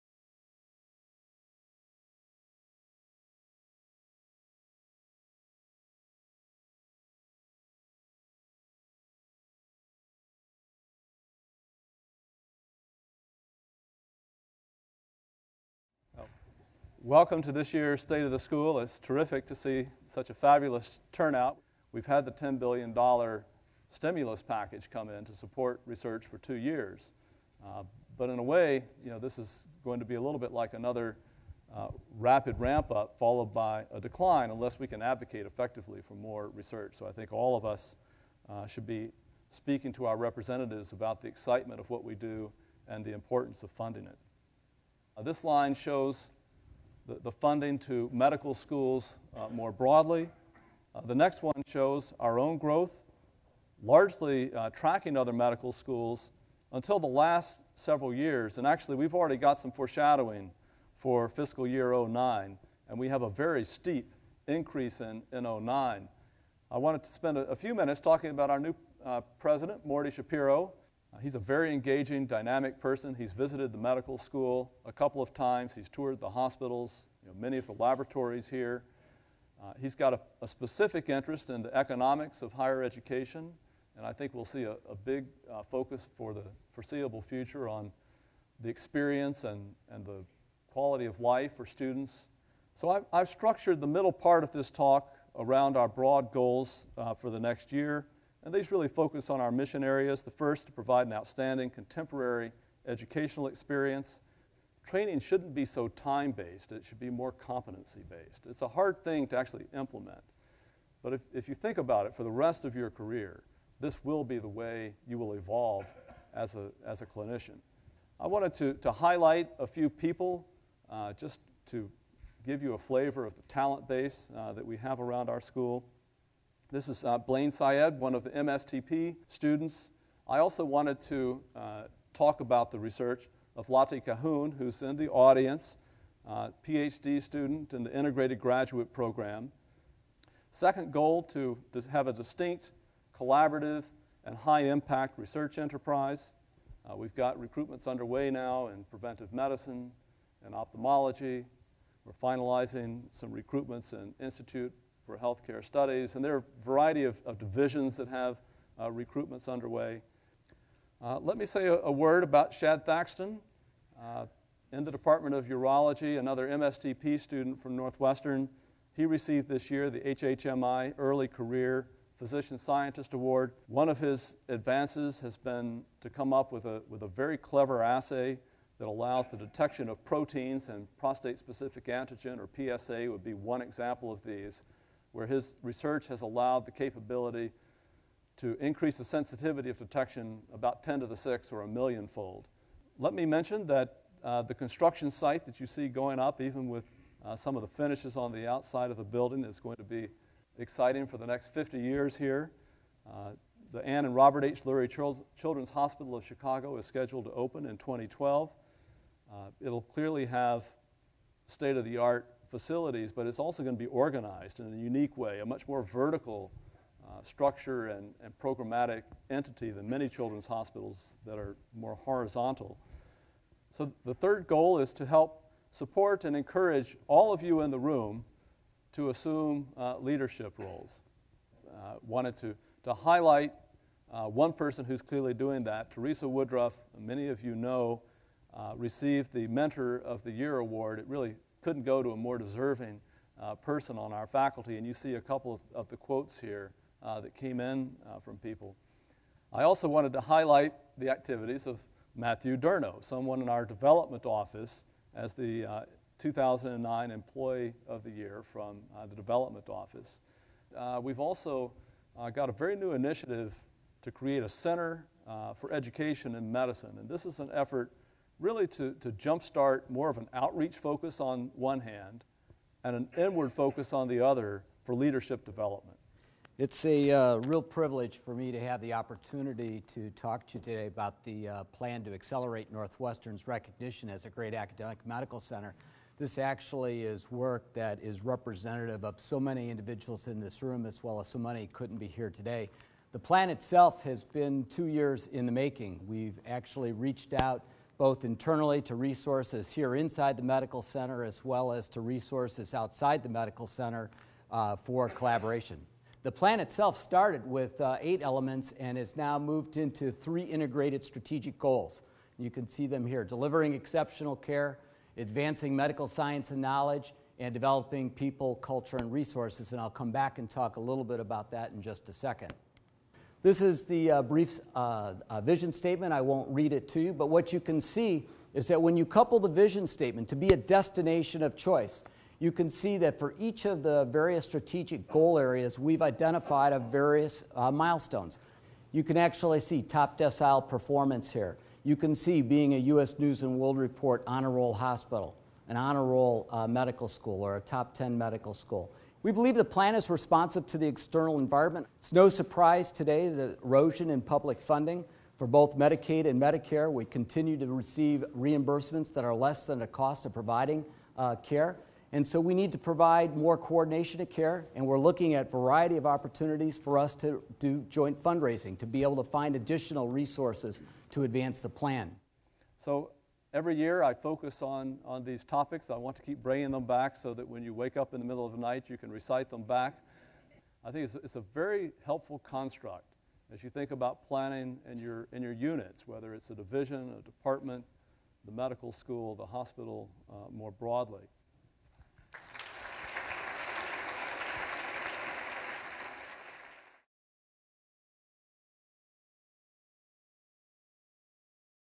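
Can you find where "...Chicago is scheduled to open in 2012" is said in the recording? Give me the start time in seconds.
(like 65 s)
206 s.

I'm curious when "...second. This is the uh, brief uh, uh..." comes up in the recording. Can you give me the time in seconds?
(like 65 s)
322 s.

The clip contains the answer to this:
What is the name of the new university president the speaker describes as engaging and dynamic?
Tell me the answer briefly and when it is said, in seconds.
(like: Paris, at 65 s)
Morty Schapiro, at 69 s.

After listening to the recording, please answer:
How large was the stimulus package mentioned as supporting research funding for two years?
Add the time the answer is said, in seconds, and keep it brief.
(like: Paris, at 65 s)
$10 billion, at 22 s.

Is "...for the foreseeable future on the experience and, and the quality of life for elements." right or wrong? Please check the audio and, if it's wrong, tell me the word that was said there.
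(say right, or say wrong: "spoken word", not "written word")
wrong: "students", not "elements".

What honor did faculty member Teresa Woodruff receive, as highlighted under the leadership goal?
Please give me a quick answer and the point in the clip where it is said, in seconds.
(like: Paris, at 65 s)
Mentor of the Year, at 239 s.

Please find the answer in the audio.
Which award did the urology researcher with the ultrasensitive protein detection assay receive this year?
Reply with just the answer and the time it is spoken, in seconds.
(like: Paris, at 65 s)
HHMI Early Career Physician Scientist Award, at 170 s.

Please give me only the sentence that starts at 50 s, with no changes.
Uh, the next one shows our own growth, largely uh, tracking other medical schools until the last several years.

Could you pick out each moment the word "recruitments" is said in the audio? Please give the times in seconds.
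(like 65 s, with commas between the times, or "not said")
147 s, 153 s, 158 s.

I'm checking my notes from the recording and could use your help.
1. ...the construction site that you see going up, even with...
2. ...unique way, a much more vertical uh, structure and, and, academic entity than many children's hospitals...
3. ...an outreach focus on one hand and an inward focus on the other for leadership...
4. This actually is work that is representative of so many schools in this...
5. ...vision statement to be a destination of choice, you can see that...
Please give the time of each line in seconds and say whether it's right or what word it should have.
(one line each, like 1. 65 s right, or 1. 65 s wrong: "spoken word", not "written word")
1. 194 s right
2. 214 s wrong: "programmatic", not "academic"
3. 270 s right
4. 286 s wrong: "individuals", not "schools"
5. 329 s right.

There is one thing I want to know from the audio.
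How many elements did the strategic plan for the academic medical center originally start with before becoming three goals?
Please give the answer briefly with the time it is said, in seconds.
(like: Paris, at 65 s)
8, at 308 s.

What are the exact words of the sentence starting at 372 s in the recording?
So every year I focus on, on these topics.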